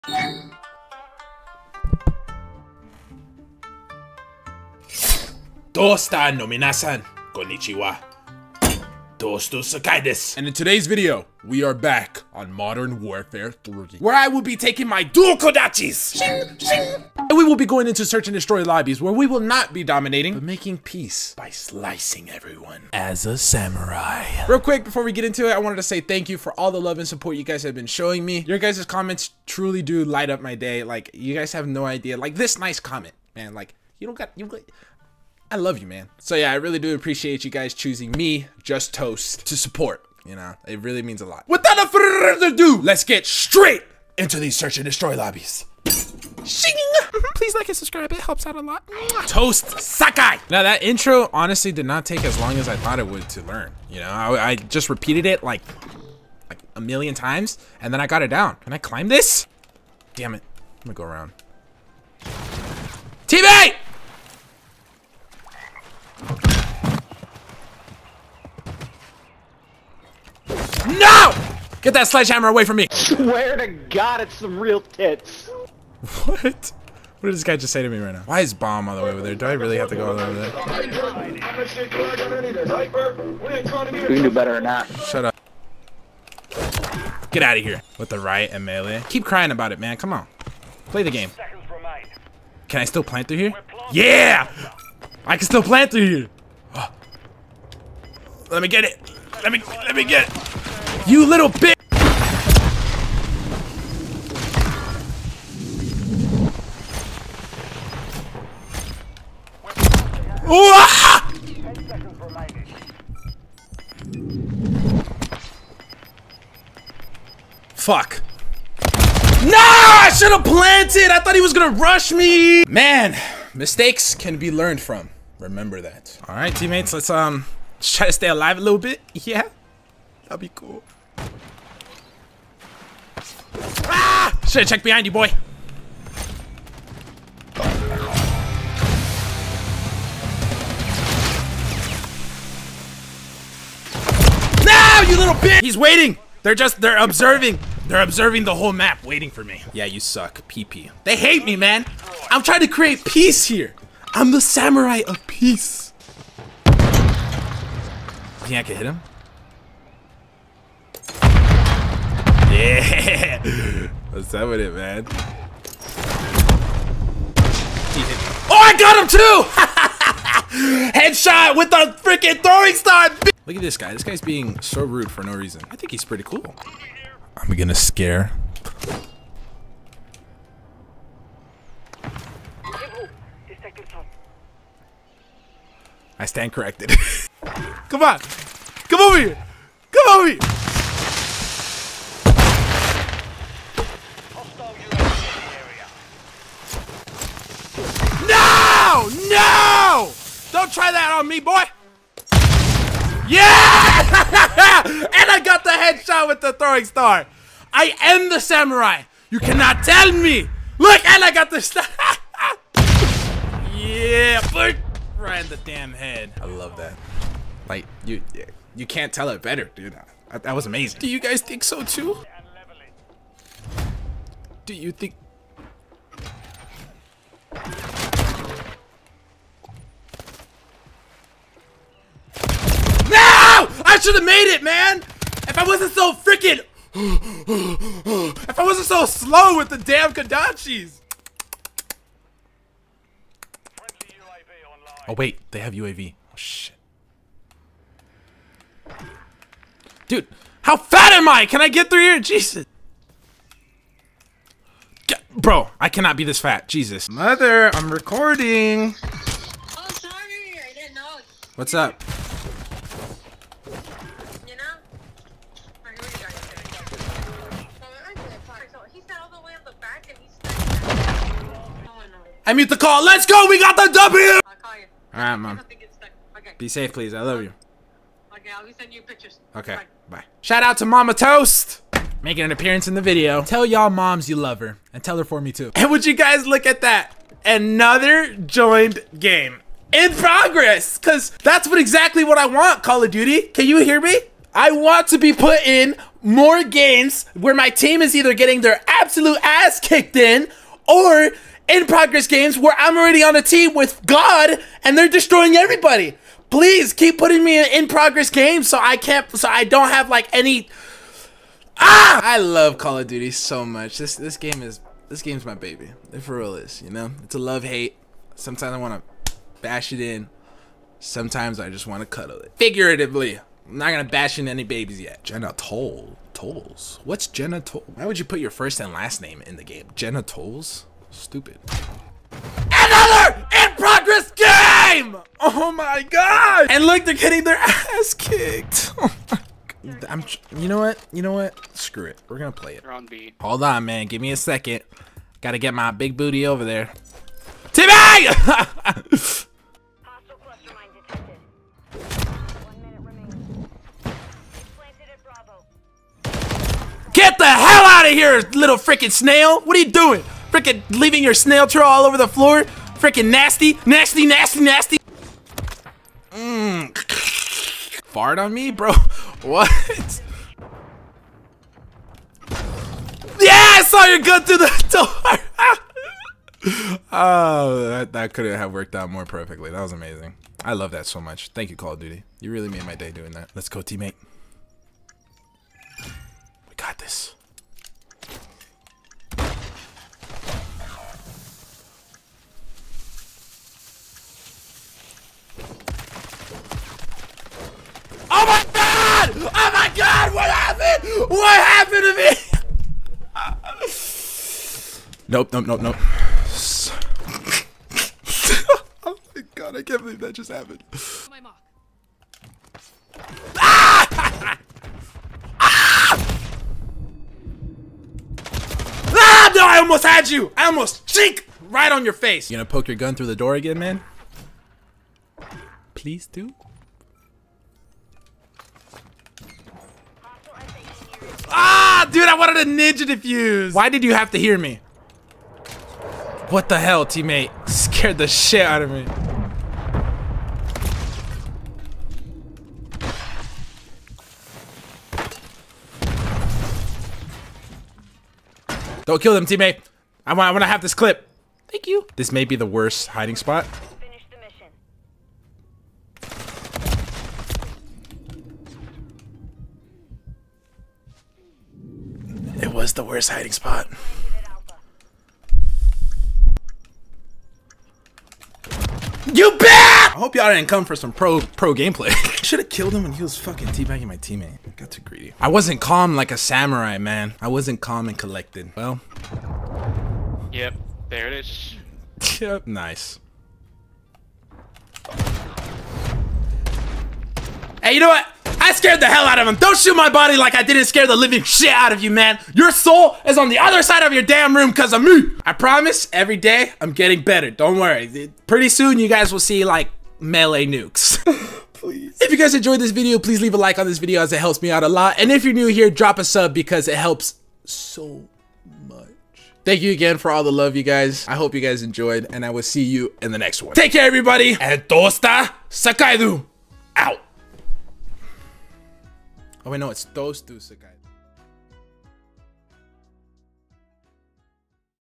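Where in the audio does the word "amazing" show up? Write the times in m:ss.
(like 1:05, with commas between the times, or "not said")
3:40, 6:19.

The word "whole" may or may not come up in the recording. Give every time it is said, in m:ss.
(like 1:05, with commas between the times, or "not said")
2:28.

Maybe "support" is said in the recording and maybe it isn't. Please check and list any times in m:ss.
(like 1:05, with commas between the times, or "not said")
0:27, 0:39.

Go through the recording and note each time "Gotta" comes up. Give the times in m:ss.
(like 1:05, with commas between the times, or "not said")
5:45.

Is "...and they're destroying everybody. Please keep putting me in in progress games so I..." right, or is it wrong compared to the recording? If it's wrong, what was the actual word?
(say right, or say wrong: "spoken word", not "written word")
right.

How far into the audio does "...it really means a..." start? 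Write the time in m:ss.
0:40.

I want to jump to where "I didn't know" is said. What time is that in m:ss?
4:20.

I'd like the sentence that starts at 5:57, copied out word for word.
Get the hell out of here, little freaking snail!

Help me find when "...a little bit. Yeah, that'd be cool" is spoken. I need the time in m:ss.
2:08.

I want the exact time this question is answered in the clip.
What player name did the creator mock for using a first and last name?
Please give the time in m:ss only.
5:29.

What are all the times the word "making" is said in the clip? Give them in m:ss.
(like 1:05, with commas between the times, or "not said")
0:20, 4:42.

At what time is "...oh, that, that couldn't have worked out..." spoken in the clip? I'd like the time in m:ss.
6:17.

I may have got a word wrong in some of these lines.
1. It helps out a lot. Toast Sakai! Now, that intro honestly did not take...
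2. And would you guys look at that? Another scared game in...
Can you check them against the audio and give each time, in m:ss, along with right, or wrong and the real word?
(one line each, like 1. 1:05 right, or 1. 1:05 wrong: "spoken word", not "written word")
1. 0:48 right
2. 4:45 wrong: "joined", not "scared".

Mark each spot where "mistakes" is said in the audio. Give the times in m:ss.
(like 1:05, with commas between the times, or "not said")
2:03.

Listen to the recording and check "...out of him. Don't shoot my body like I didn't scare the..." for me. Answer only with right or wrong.
right.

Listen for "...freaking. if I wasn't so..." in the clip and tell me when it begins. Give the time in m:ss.
3:56.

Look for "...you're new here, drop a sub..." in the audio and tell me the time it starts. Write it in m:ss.
8:25.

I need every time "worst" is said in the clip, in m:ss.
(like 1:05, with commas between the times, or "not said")
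7:32, 7:43.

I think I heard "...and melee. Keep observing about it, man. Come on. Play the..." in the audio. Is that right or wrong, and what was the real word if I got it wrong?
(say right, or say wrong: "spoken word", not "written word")
wrong: "crying", not "observing".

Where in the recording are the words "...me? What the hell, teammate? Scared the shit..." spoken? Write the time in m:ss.
7:14.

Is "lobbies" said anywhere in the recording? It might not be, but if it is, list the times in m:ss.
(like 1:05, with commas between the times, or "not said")
0:18, 0:45.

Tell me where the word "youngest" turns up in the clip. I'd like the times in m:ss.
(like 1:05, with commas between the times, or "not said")
not said.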